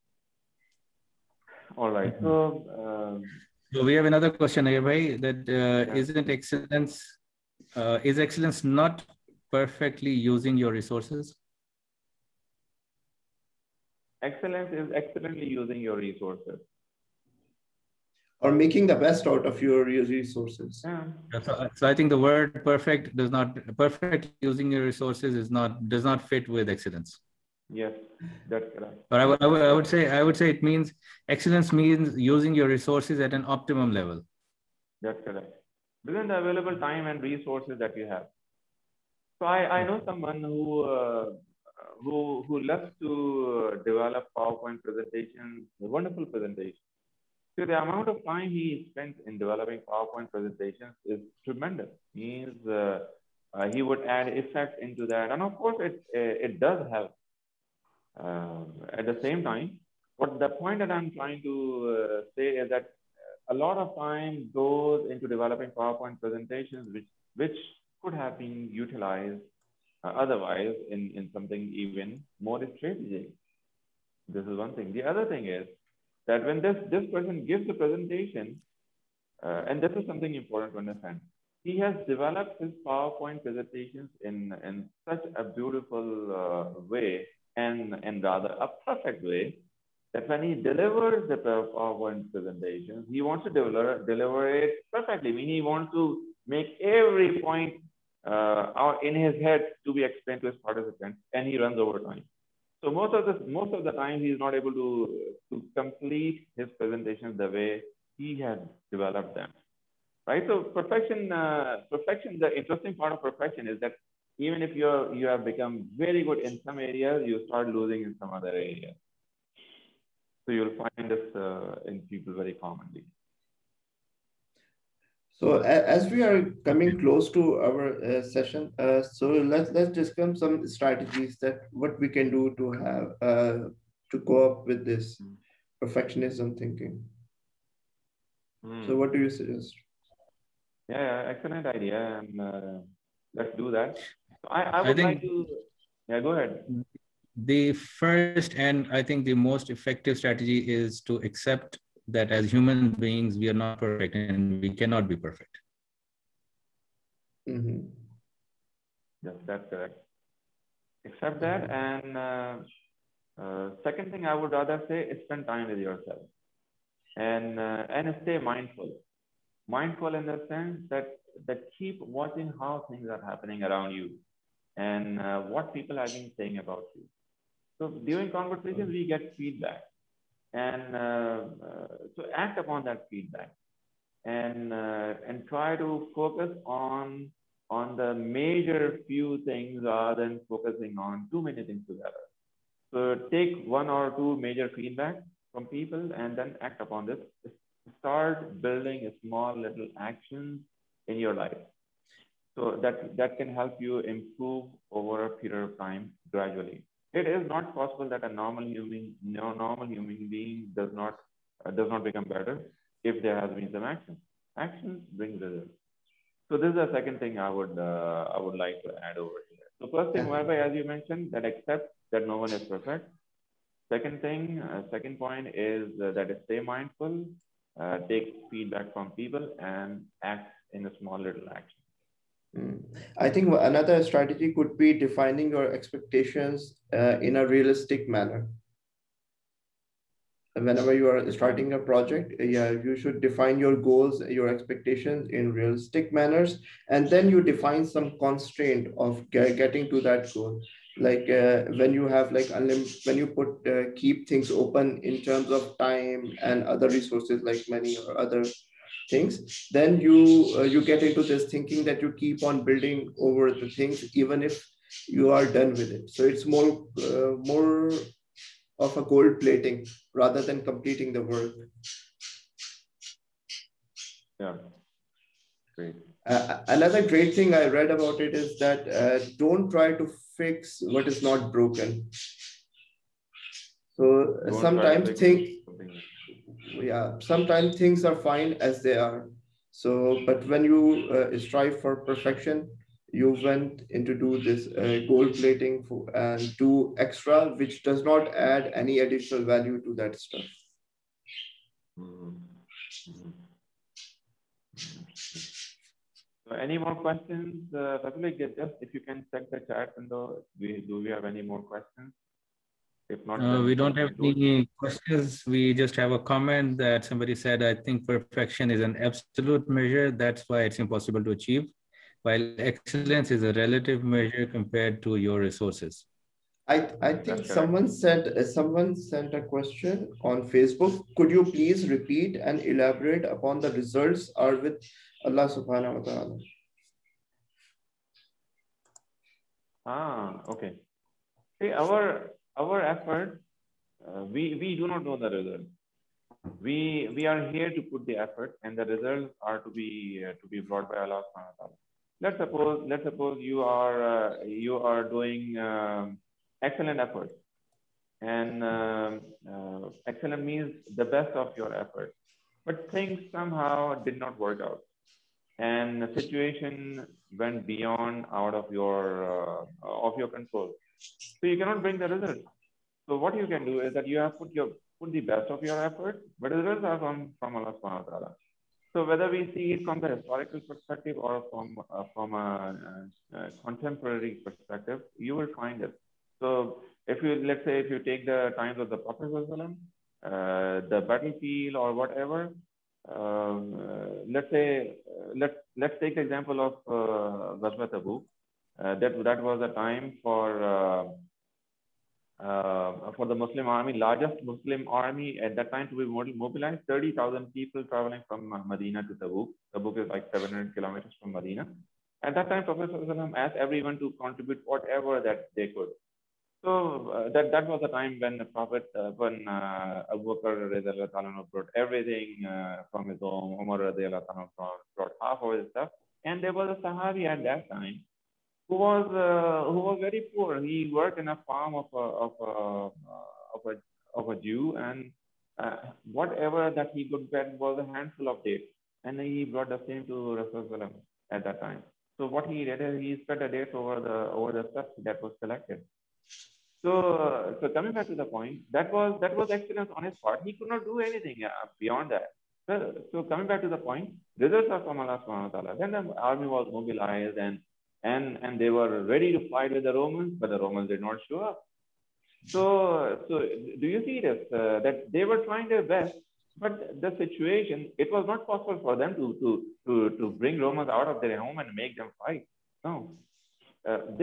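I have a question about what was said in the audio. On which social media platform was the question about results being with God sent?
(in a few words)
Facebook.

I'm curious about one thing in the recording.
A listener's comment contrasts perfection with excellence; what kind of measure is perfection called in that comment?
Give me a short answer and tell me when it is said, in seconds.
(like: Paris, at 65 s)
absolute measure, at 318 s.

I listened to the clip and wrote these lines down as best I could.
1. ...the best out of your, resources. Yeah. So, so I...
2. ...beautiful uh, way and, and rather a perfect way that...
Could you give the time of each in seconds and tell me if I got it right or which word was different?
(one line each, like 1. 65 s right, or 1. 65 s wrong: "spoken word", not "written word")
1. 18 s right
2. 85 s right.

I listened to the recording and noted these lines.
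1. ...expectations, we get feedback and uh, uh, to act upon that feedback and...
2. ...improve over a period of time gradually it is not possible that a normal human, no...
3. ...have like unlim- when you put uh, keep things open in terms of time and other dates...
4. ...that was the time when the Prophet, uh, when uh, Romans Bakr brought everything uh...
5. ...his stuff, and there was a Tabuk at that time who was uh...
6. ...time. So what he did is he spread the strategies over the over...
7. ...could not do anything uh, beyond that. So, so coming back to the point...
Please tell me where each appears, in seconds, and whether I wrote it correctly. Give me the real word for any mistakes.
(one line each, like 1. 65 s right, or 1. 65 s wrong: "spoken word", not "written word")
1. 178 s wrong: "conversations", not "expectations"
2. 203 s right
3. 252 s wrong: "resources", not "dates"
4. 417 s wrong: "Abu", not "Romans"
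5. 425 s wrong: "Sahabi", not "Tabuk"
6. 441 s wrong: "dates", not "strategies"
7. 450 s right.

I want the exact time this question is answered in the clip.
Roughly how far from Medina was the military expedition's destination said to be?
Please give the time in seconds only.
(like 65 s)
410 s.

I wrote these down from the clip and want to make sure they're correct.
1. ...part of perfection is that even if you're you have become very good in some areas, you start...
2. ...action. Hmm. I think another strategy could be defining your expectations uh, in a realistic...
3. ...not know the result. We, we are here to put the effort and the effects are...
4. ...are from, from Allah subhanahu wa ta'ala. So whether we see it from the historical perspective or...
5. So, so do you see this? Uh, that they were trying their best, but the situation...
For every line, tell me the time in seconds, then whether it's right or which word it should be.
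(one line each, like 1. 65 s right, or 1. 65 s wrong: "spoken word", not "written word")
1. 112 s right
2. 231 s right
3. 344 s wrong: "results", not "effects"
4. 376 s right
5. 462 s right.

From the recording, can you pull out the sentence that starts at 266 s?
So it's more uh, more of a gold plating rather than completing the work.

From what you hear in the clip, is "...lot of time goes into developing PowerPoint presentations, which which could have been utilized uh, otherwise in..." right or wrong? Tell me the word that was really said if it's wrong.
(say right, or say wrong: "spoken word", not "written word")
right.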